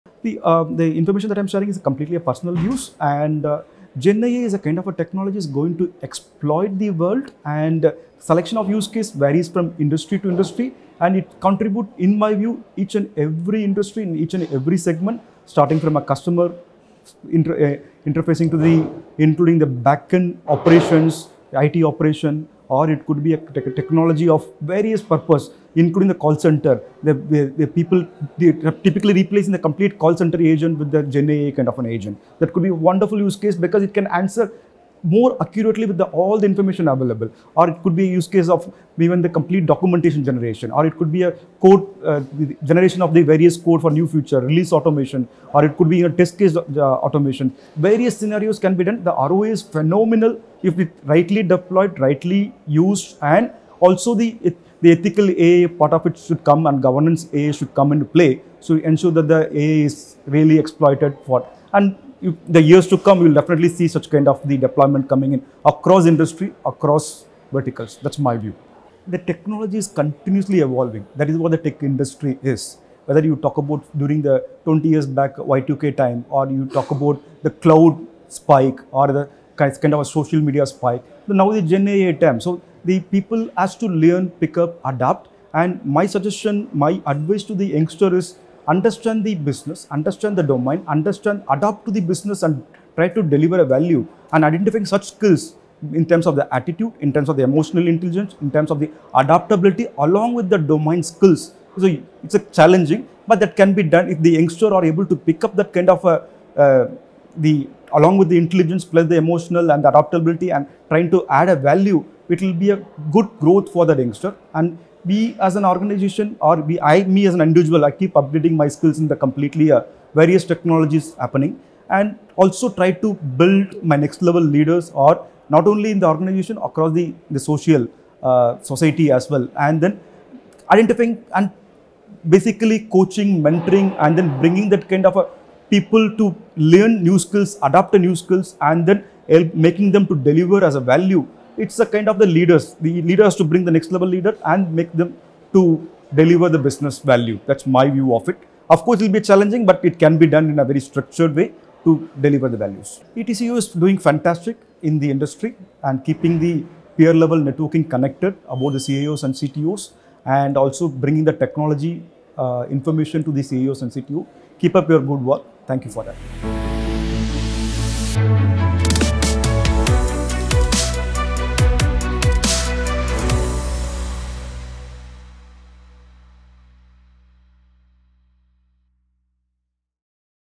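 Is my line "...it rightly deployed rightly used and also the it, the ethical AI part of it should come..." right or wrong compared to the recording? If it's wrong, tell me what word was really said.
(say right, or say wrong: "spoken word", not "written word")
right.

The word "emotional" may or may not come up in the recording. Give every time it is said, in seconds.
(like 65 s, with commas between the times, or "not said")
97 s, 109 s.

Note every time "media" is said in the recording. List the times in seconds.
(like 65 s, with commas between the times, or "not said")
80 s.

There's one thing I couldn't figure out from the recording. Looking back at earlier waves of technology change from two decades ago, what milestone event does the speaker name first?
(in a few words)
Y2K.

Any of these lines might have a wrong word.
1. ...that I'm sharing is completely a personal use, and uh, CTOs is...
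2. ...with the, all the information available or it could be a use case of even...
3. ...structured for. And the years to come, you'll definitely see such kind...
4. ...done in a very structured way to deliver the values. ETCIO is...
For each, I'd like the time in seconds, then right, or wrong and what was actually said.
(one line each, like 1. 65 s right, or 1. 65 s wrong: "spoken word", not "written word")
1. 1 s wrong: "GenAI", not "CTOs"
2. 35 s right
3. 60 s wrong: "exploited", not "structured"
4. 150 s right.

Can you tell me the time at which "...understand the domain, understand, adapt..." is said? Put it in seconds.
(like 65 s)
89 s.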